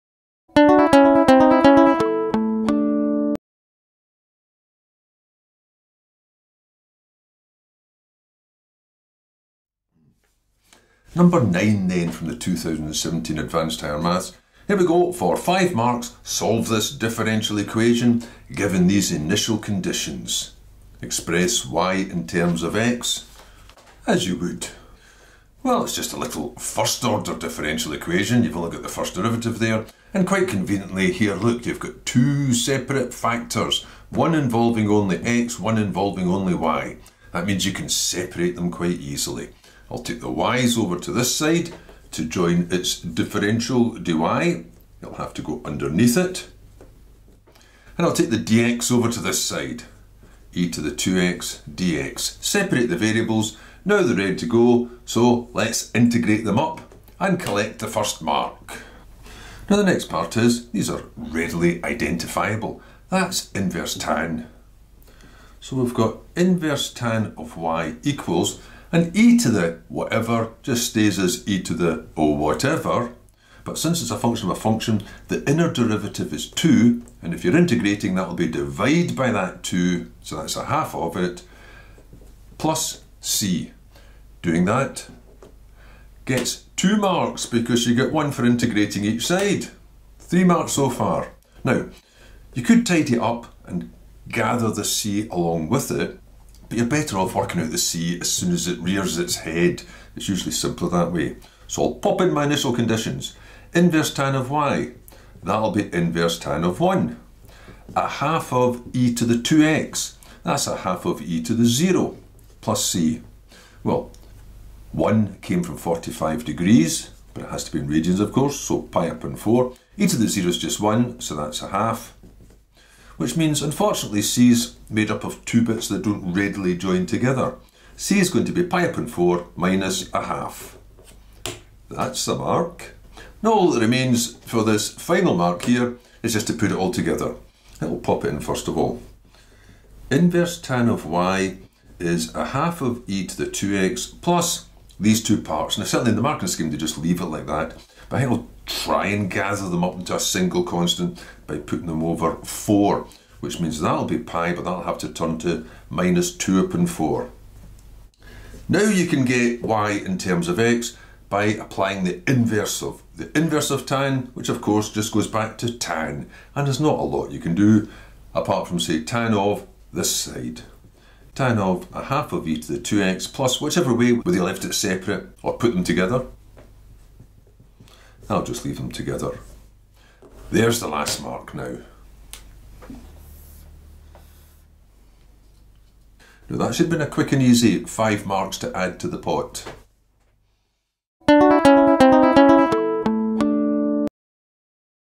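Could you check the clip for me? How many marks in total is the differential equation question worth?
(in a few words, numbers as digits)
5.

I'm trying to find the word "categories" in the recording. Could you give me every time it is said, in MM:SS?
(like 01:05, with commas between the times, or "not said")
not said.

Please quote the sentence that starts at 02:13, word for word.
Now all that remains for this final mark here is just to put it all together.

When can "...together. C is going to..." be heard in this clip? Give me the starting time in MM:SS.
02:07.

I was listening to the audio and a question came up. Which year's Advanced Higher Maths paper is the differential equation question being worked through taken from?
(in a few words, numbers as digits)
2017.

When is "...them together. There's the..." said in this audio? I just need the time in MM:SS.
02:58.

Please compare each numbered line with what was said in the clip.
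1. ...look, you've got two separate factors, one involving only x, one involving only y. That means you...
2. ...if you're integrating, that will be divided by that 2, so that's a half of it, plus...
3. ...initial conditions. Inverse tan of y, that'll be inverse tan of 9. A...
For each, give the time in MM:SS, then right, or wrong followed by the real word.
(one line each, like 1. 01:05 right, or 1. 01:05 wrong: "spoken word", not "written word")
1. 00:31 right
2. 01:17 right
3. 01:42 wrong: "1", not "9".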